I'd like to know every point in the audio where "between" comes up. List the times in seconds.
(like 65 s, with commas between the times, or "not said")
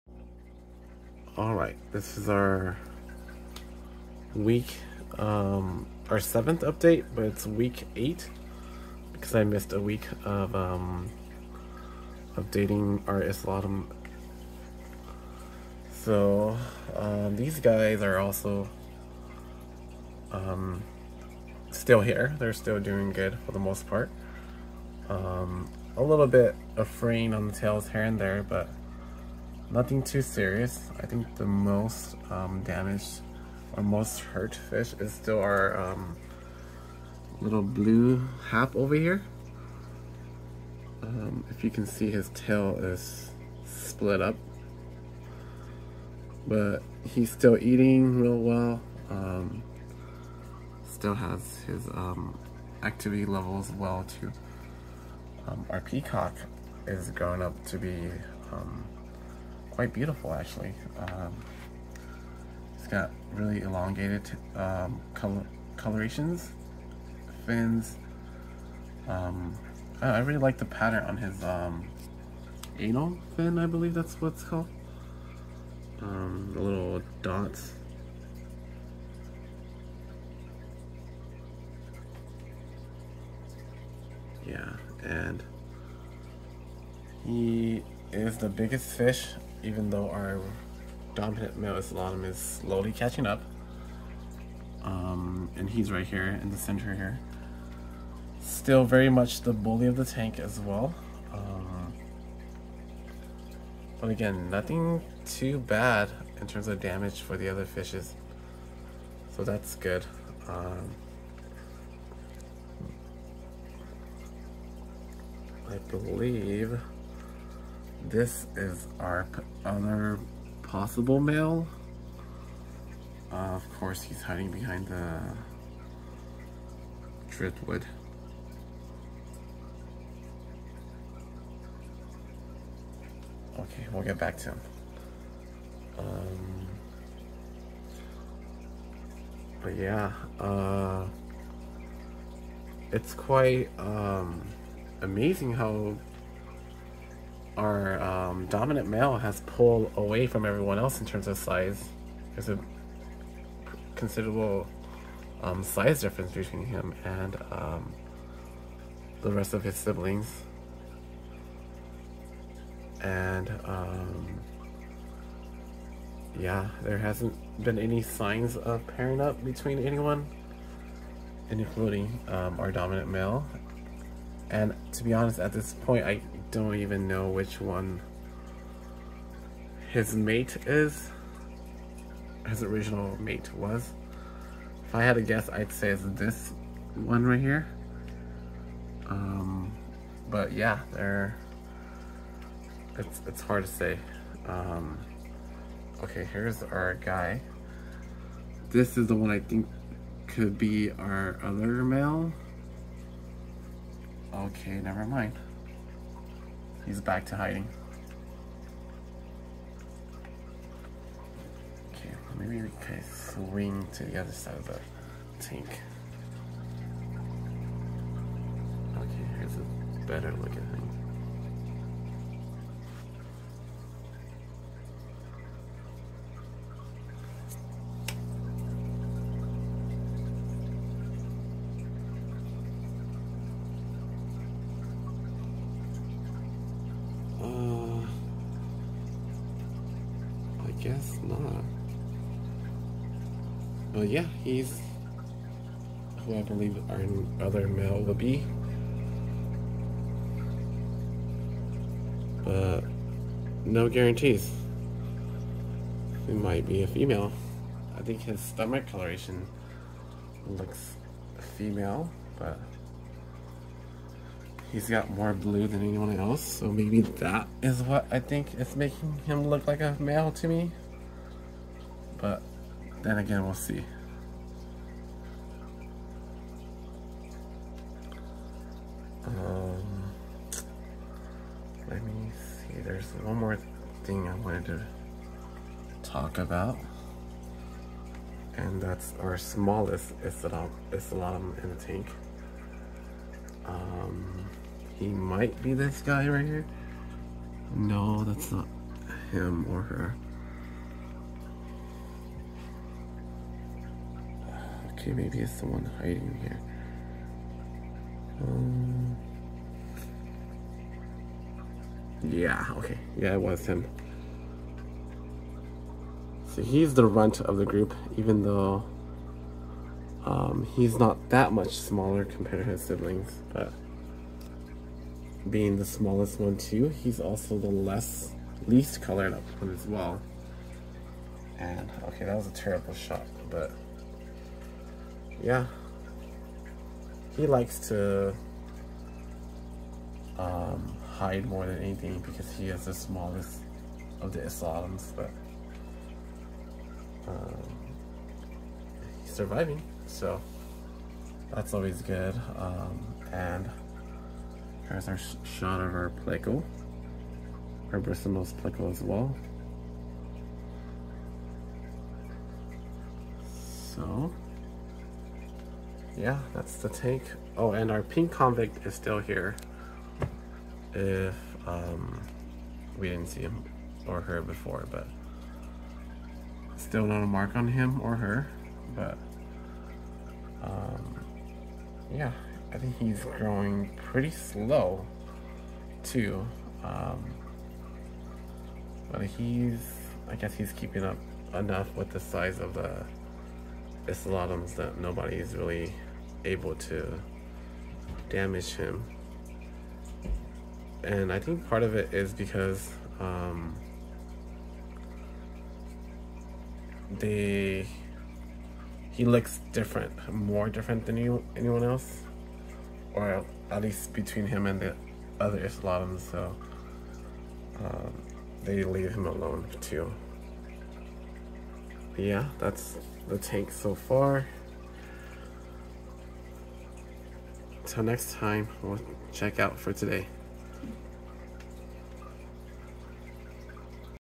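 156 s, 169 s, 414 s.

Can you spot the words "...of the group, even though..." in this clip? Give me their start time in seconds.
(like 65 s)
317 s.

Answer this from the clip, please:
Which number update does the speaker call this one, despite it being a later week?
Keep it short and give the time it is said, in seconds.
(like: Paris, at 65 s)
Seventh, at 6 s.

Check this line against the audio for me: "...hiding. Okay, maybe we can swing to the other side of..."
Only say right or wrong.
right.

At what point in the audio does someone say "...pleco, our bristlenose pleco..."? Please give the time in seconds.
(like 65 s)
356 s.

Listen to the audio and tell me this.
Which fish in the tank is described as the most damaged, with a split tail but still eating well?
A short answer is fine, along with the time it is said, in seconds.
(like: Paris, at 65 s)
Blue hap, at 37 s.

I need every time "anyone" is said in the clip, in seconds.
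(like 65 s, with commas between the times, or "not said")
169 s, 265 s, 411 s.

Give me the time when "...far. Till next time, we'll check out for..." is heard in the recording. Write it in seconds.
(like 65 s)
423 s.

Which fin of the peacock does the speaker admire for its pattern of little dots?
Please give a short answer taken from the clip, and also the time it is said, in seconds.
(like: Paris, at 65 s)
Anal fin, at 72 s.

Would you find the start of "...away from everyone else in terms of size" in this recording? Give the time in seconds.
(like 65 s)
149 s.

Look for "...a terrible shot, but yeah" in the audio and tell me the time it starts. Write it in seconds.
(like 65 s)
332 s.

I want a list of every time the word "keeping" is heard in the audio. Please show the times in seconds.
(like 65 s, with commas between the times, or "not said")
390 s.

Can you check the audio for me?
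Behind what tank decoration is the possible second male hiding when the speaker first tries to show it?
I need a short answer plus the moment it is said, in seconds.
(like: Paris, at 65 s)
Driftwood, at 127 s.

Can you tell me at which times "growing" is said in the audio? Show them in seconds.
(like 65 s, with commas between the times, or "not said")
57 s, 383 s.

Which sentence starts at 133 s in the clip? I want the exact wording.
Okay, we'll get back to him.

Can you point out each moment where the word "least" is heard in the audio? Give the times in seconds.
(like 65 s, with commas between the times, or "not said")
328 s, 413 s.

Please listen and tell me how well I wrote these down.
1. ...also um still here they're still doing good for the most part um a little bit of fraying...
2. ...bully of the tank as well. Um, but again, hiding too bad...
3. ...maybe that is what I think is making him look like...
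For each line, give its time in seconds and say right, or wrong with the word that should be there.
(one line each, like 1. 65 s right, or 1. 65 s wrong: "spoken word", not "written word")
1. 18 s right
2. 99 s wrong: "nothing", not "hiding"
3. 266 s right.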